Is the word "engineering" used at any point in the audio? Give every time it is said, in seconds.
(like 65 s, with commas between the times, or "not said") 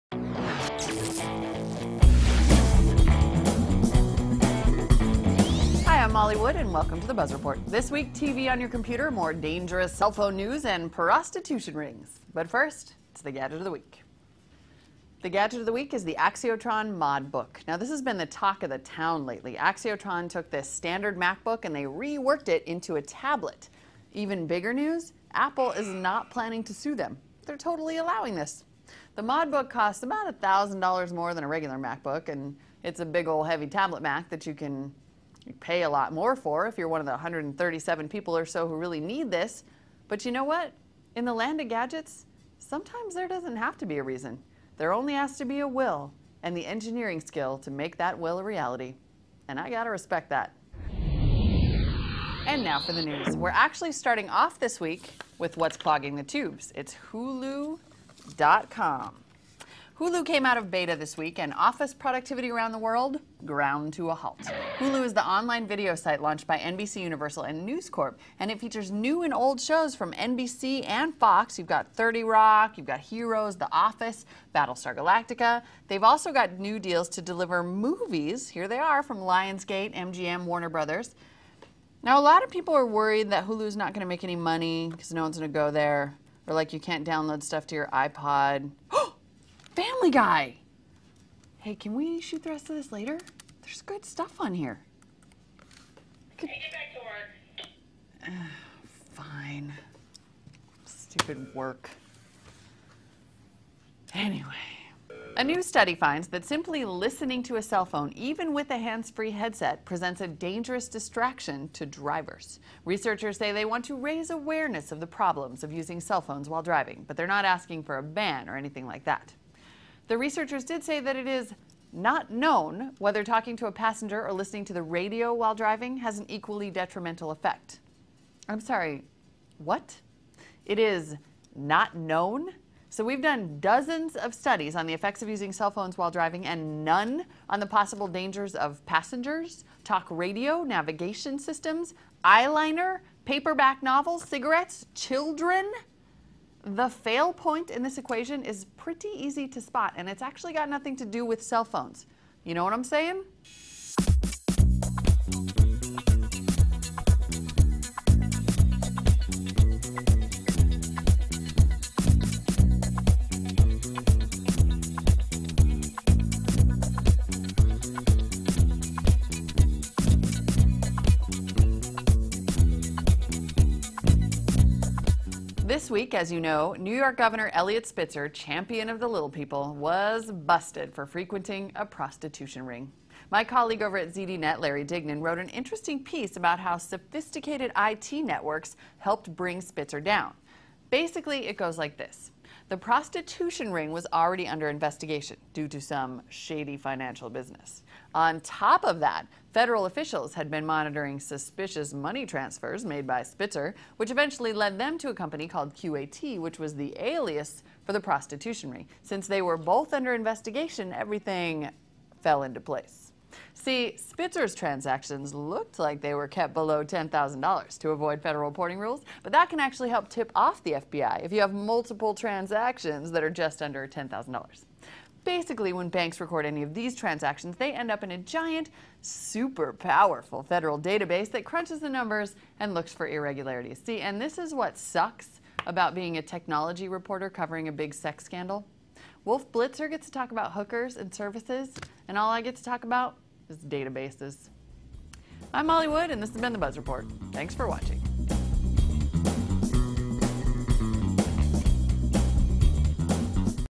46 s.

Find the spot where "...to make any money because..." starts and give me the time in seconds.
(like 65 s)
84 s.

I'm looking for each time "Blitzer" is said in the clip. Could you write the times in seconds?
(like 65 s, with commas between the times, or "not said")
239 s.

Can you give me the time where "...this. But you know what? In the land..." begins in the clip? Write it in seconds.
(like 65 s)
39 s.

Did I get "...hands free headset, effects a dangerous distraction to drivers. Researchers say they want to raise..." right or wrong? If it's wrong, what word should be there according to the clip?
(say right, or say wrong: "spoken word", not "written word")
wrong: "presents", not "effects".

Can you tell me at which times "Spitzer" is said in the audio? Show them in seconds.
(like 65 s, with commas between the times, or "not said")
177 s, 189 s, 203 s, 213 s.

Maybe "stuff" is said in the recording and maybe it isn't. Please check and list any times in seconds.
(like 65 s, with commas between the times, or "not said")
87 s, 94 s.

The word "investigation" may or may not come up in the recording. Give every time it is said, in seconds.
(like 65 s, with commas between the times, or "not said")
194 s, 210 s.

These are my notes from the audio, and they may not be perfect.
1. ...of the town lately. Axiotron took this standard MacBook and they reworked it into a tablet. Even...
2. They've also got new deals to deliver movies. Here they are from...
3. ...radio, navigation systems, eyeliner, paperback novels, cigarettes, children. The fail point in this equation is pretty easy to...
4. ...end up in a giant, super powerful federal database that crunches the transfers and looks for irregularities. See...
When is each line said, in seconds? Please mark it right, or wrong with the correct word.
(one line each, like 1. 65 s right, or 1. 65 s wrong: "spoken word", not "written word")
1. 18 s right
2. 75 s right
3. 140 s right
4. 227 s wrong: "numbers", not "transfers".